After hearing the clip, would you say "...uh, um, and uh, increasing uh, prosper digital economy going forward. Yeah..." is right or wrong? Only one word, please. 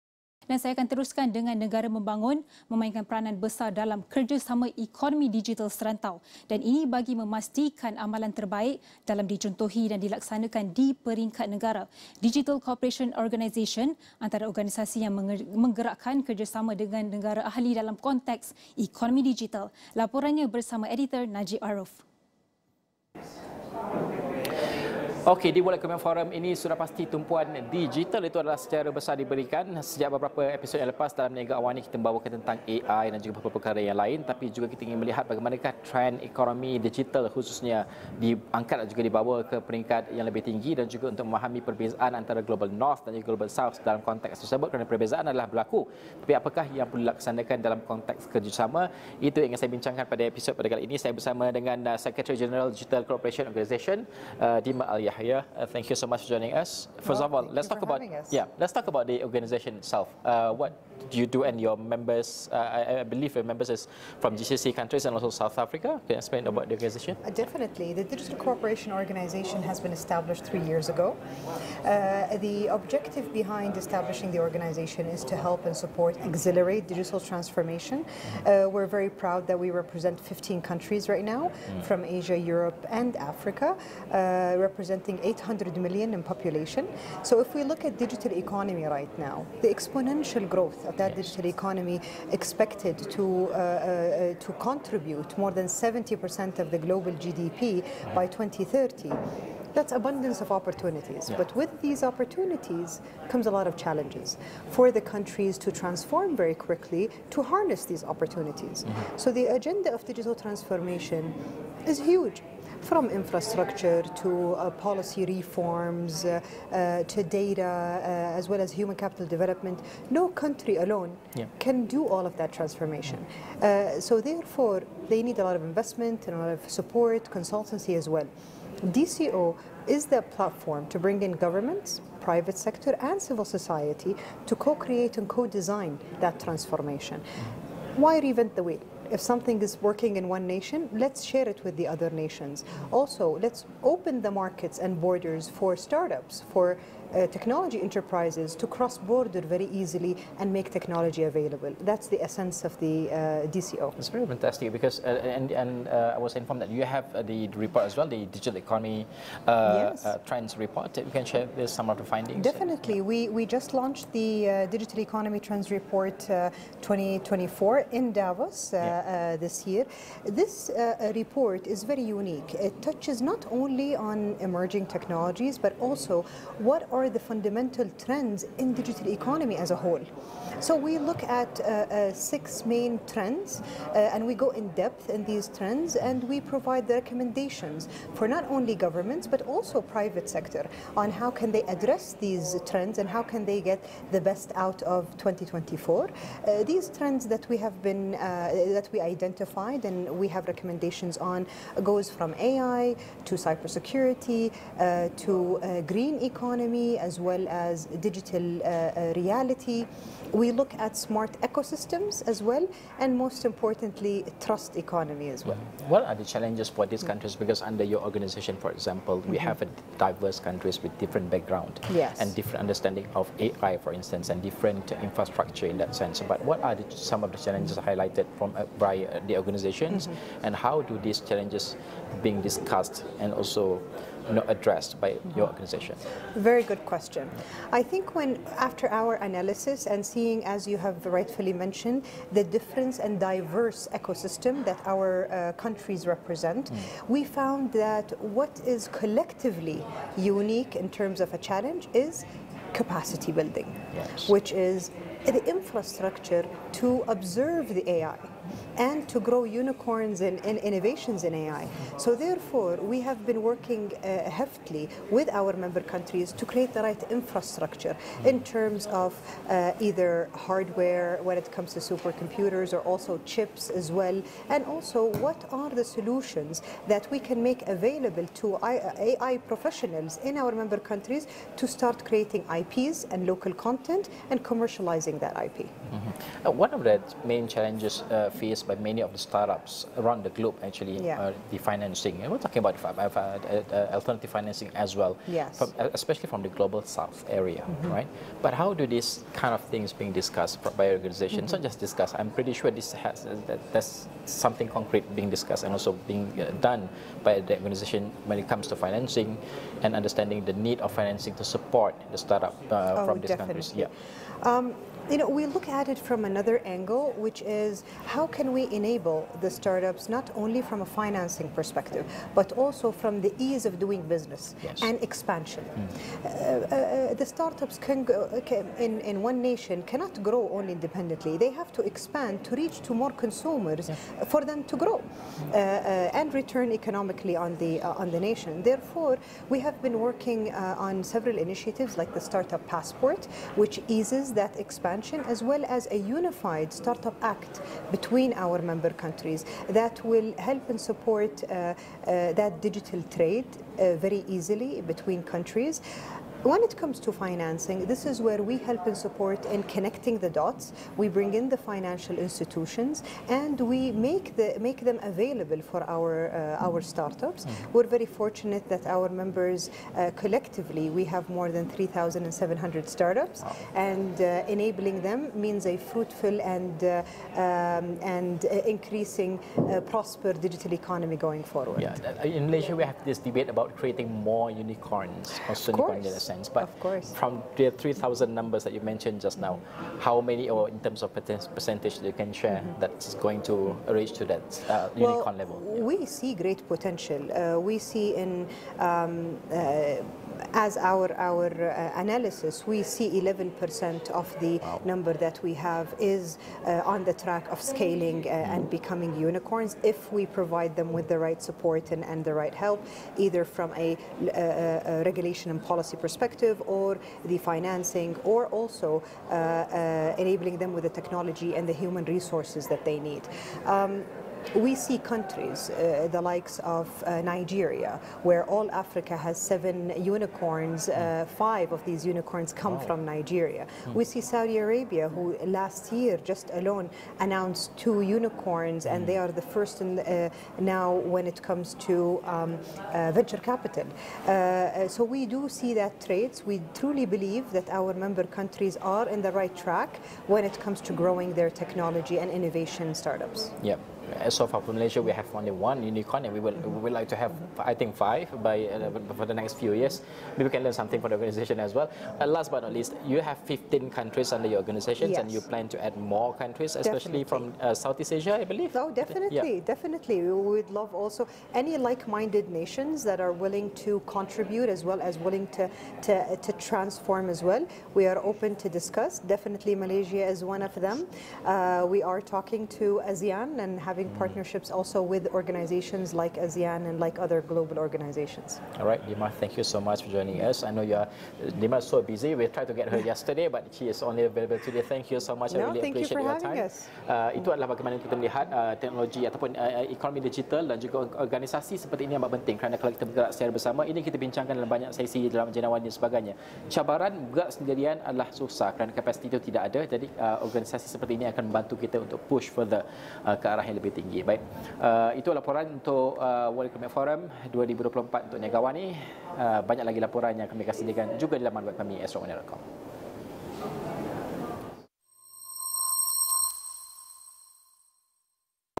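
right.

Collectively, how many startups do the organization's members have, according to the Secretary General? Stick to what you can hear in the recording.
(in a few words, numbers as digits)
More than 3,700.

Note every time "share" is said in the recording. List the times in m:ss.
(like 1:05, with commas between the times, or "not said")
2:21, 2:41, 6:32.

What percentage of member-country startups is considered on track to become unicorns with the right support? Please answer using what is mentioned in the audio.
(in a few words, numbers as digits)
11%.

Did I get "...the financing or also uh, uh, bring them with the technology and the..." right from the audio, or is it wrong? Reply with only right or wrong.
wrong.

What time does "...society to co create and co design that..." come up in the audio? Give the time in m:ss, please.
2:13.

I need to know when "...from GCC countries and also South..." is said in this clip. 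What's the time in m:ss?
1:04.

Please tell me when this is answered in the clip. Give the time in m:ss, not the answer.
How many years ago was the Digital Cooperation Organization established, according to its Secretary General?
1:10.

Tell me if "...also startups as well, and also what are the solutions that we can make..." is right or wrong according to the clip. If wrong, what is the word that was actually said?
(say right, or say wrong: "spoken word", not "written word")
wrong: "chips", not "startups".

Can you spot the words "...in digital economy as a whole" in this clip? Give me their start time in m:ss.
2:58.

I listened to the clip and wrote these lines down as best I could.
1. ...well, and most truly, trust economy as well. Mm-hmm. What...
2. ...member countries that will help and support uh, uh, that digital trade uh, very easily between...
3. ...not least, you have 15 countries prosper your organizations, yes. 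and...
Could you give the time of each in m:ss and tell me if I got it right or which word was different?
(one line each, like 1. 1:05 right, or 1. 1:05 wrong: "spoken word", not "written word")
1. 3:32 wrong: "importantly", not "truly"
2. 5:48 right
3. 7:42 wrong: "under", not "prosper".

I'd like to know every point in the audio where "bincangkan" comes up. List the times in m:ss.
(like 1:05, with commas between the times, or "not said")
0:49, 8:24.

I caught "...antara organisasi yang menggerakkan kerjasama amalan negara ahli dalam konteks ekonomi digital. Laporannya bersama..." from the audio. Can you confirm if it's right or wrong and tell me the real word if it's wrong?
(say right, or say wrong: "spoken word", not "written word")
wrong: "dengan", not "amalan".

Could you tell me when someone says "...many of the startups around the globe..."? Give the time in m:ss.
4:48.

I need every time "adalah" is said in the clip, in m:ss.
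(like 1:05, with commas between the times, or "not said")
0:28, 0:45, 8:17, 8:28.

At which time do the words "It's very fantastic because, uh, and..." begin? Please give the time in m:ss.
2:33.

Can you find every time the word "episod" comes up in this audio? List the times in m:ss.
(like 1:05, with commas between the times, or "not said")
0:30, 0:50.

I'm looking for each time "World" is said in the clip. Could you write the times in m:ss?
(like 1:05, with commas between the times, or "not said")
0:25, 8:36.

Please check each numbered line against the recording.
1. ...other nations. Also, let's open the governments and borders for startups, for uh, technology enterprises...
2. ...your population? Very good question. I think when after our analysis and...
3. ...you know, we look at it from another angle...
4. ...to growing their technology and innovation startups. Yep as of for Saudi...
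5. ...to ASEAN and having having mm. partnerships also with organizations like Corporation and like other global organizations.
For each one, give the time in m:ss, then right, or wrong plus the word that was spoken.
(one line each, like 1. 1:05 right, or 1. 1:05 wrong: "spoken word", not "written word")
1. 2:21 wrong: "markets", not "governments"
2. 3:55 wrong: "organization", not "population"
3. 5:15 right
4. 7:30 wrong: "Malaysia", not "Saudi"
5. 8:02 wrong: "ASEAN", not "Corporation".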